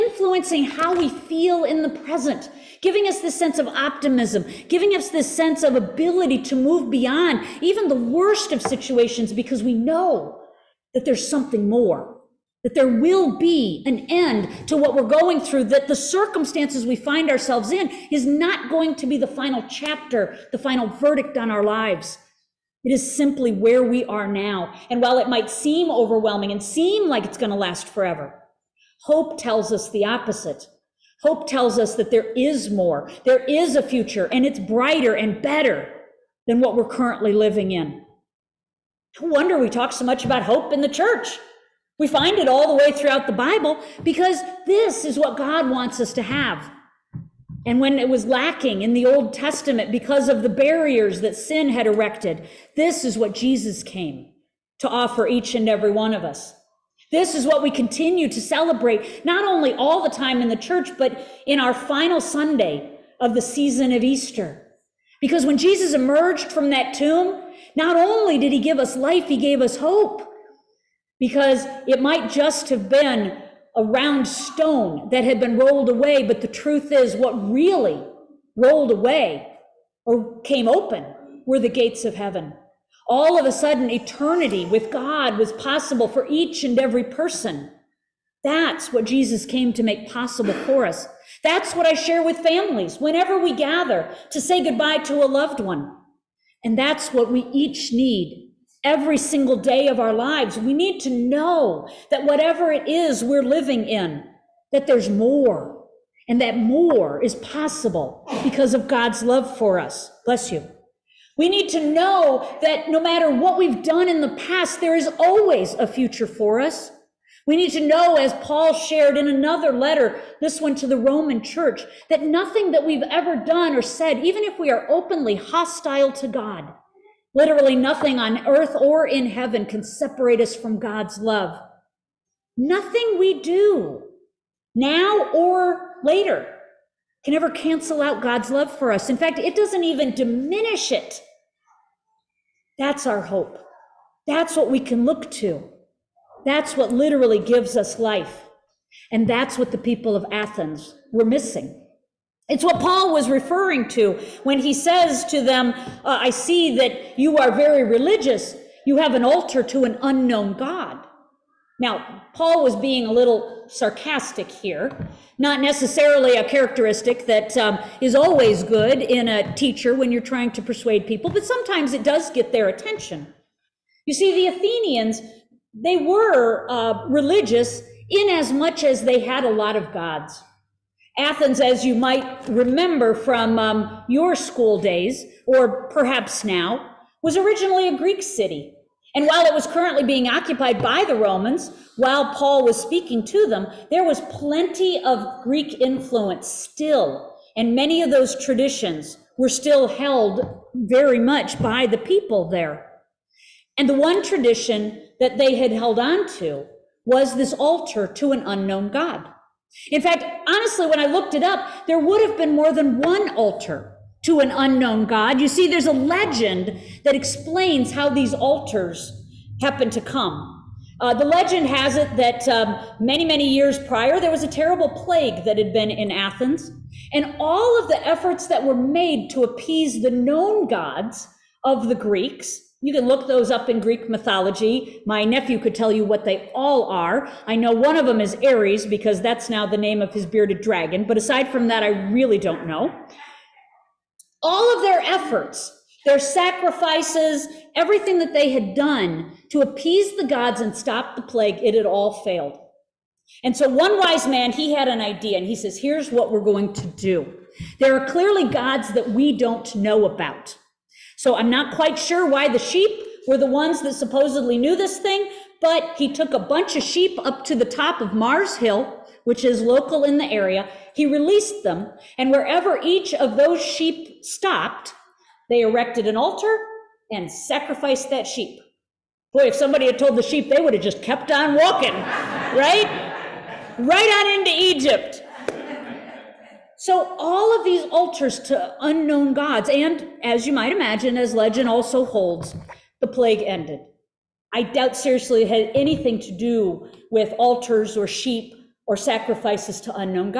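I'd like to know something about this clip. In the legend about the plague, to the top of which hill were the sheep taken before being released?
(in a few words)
Mars Hill.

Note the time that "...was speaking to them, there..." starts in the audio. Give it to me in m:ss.
3:12.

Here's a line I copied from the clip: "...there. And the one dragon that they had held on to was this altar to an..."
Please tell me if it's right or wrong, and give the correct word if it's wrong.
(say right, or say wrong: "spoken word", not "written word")
wrong: "tradition", not "dragon".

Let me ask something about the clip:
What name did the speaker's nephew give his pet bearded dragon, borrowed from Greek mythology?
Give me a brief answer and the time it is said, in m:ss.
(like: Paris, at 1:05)
Ares, at 3:58.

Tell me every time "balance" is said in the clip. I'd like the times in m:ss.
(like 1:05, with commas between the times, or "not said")
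not said.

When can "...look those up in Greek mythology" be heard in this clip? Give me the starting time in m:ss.
3:53.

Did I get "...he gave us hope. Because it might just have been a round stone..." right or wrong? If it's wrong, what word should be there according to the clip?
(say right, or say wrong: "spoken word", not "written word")
right.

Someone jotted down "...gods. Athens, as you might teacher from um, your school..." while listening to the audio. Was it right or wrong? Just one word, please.
wrong.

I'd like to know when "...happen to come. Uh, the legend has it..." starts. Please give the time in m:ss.
3:39.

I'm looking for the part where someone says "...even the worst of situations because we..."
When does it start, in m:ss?
0:07.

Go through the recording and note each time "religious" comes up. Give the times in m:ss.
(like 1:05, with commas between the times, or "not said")
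2:37, 2:57.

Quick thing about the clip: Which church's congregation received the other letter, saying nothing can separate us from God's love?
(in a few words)
the Roman church.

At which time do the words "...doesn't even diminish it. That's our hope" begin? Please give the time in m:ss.
2:19.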